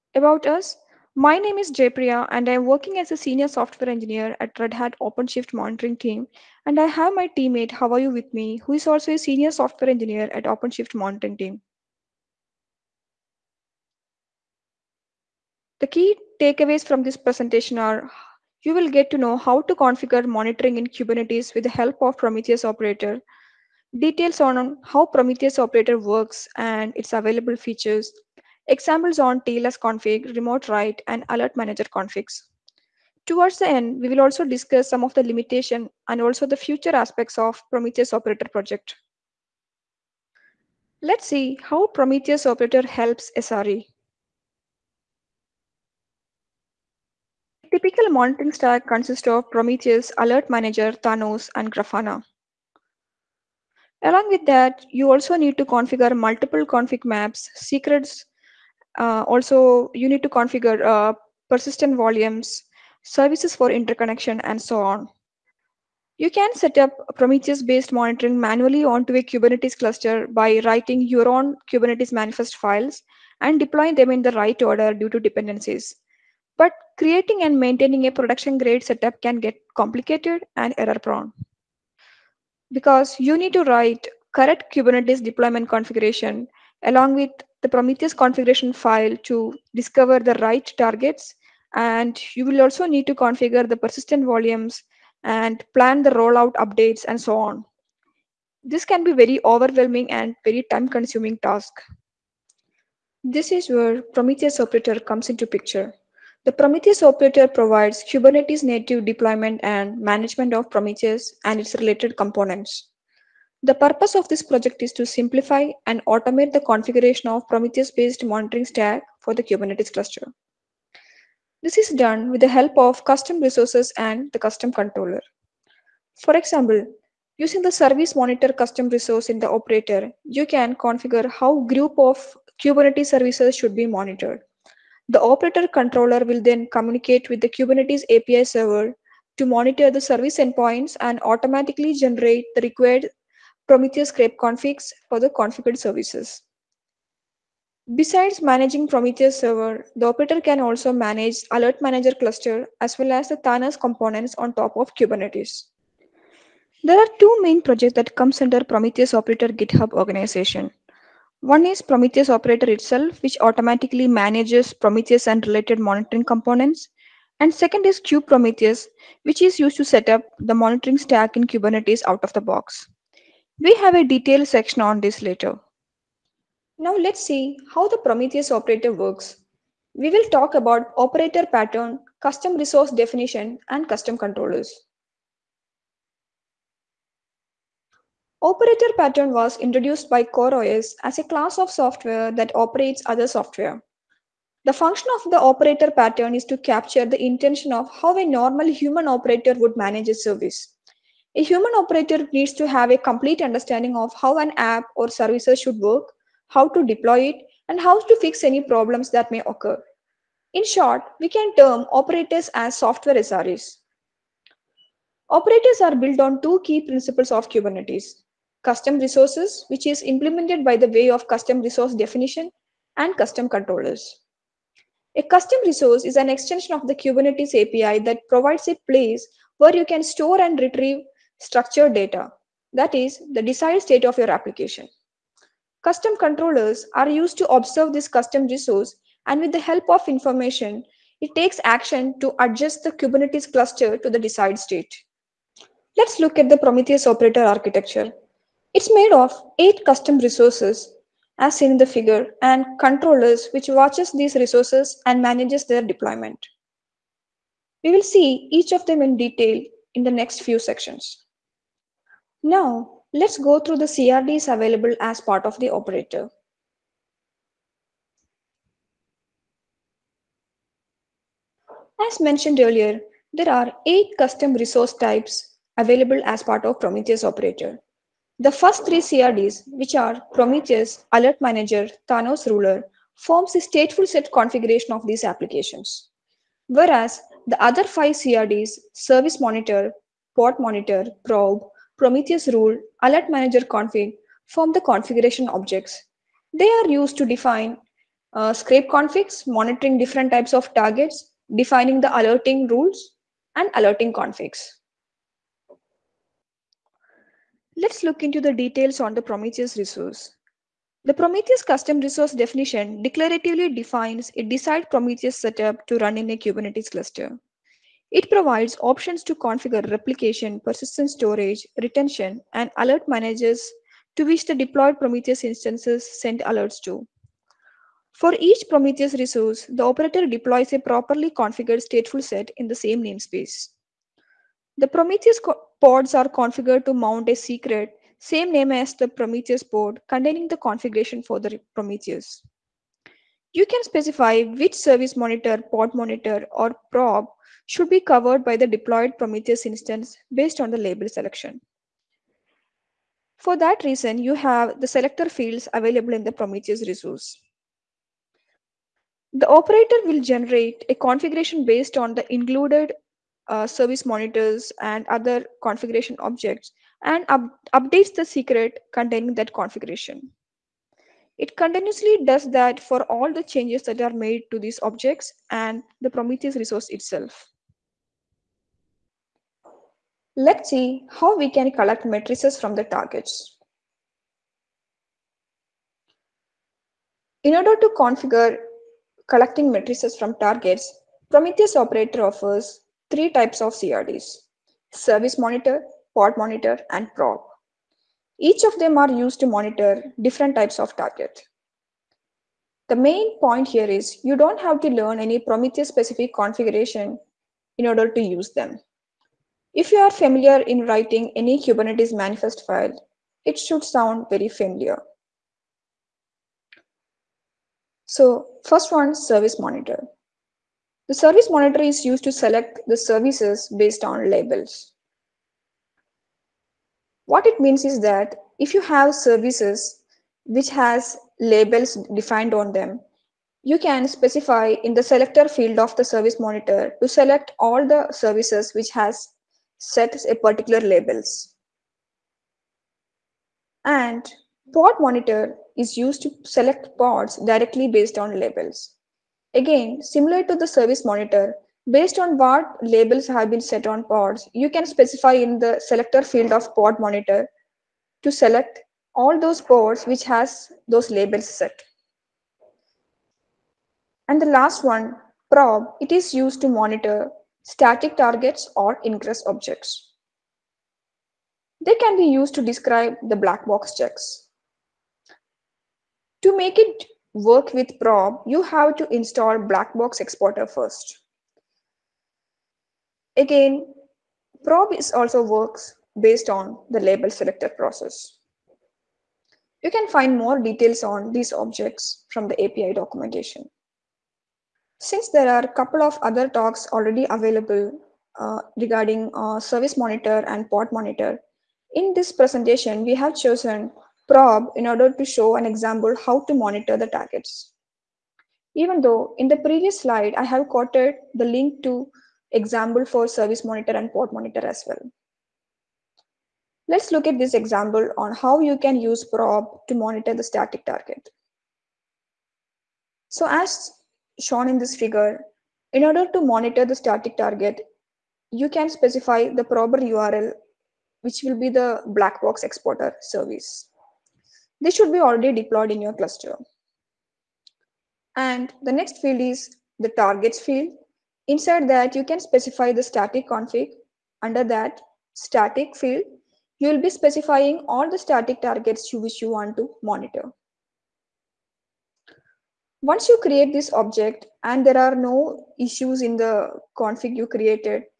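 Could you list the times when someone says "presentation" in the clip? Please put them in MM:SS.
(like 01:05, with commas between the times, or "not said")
00:17, 08:22.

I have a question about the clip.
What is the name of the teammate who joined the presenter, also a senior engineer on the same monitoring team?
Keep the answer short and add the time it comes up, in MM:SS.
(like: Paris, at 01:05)
Haoyu, at 00:07.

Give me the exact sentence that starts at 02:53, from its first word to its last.
We have a detailed section on this later.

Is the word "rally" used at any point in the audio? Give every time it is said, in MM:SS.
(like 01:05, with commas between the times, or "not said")
not said.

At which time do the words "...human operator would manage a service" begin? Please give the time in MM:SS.
03:18.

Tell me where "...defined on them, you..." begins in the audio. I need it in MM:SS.
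07:12.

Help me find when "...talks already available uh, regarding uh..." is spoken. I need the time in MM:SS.
08:16.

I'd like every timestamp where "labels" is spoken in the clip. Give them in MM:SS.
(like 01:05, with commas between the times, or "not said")
05:50, 07:04, 07:11, 07:20, 07:28, 07:32, 07:41, 08:06.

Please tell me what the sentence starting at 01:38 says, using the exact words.
This can be very overwhelming and very time consuming task.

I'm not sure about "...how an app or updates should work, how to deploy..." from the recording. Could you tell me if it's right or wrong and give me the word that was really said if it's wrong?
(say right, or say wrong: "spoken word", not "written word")
wrong: "services", not "updates".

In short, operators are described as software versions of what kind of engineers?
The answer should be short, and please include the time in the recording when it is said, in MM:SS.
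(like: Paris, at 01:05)
software SREs, at 03:32.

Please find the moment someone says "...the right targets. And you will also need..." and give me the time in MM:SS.
01:30.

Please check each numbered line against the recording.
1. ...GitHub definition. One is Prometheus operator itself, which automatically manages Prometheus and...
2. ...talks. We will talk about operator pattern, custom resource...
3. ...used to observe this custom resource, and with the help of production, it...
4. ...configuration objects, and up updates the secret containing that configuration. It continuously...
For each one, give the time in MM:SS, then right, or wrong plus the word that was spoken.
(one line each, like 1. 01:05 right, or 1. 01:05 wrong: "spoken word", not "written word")
1. 02:39 wrong: "organization", not "definition"
2. 02:58 wrong: "works", not "talks"
3. 03:57 wrong: "information", not "production"
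4. 06:05 right.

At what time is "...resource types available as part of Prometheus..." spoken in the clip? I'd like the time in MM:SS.
04:34.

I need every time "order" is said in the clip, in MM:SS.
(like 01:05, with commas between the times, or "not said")
01:14, 06:27, 06:47, 08:24, 08:46.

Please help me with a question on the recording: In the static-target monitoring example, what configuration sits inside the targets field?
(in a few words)
static config.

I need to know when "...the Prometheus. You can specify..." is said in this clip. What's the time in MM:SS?
05:41.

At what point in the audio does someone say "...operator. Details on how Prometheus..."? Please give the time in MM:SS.
00:22.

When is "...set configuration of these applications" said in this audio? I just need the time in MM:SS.
04:44.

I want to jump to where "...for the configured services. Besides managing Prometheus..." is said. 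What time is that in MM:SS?
02:25.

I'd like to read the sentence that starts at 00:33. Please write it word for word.
Towards the end, we will also discuss some of the limitation and also the future aspects of Prometheus operator project.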